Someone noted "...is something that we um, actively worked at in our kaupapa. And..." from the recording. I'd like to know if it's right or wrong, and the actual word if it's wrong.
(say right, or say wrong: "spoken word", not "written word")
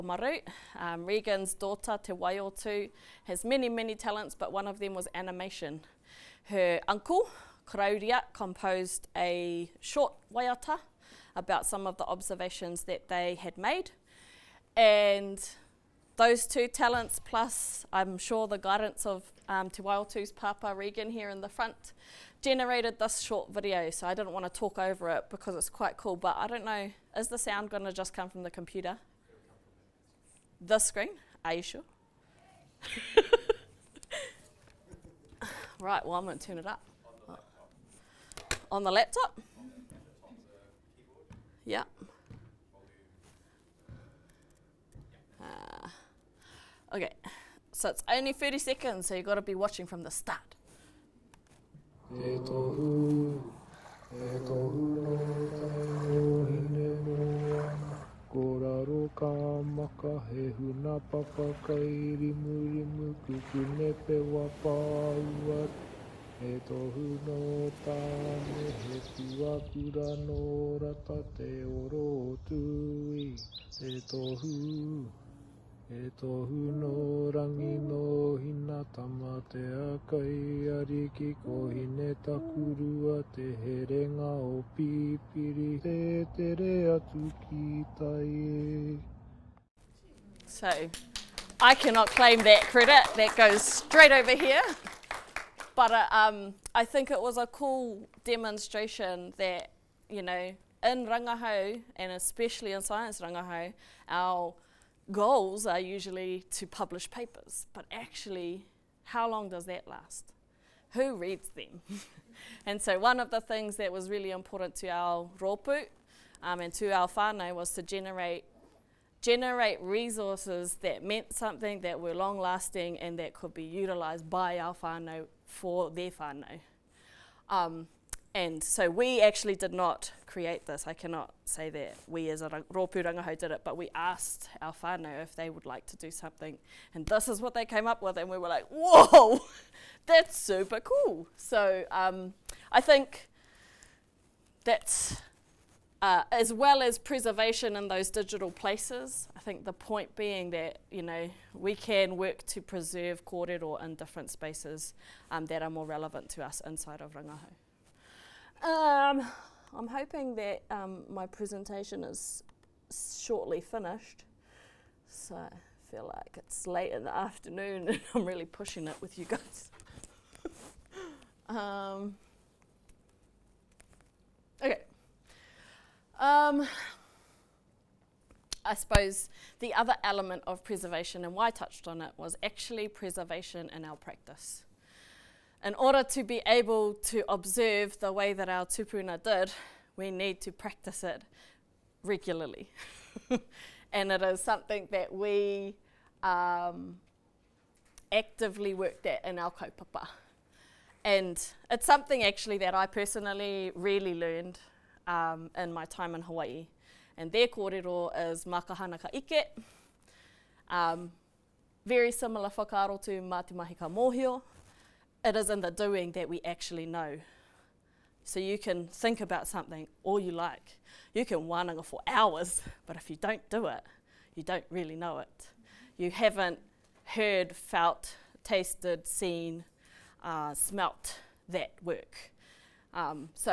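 right.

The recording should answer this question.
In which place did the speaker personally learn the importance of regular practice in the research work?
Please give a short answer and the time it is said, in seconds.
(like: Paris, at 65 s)
Hawaii, at 206 s.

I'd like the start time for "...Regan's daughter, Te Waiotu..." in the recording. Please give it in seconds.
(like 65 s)
1 s.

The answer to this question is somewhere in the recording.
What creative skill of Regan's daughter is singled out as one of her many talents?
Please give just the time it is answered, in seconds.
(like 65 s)
5 s.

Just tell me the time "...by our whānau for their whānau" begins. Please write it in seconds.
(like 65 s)
124 s.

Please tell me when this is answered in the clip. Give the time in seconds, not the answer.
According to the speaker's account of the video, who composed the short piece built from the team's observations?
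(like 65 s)
7 s.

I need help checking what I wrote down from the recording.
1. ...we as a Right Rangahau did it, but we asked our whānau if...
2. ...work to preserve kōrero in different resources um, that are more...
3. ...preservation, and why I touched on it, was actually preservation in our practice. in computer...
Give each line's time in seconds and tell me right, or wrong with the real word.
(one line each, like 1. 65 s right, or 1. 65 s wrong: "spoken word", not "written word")
1. 132 s wrong: "Rōpū", not "Right"
2. 152 s wrong: "spaces", not "resources"
3. 180 s wrong: "order", not "computer".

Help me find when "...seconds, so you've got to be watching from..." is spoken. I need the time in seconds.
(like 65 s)
48 s.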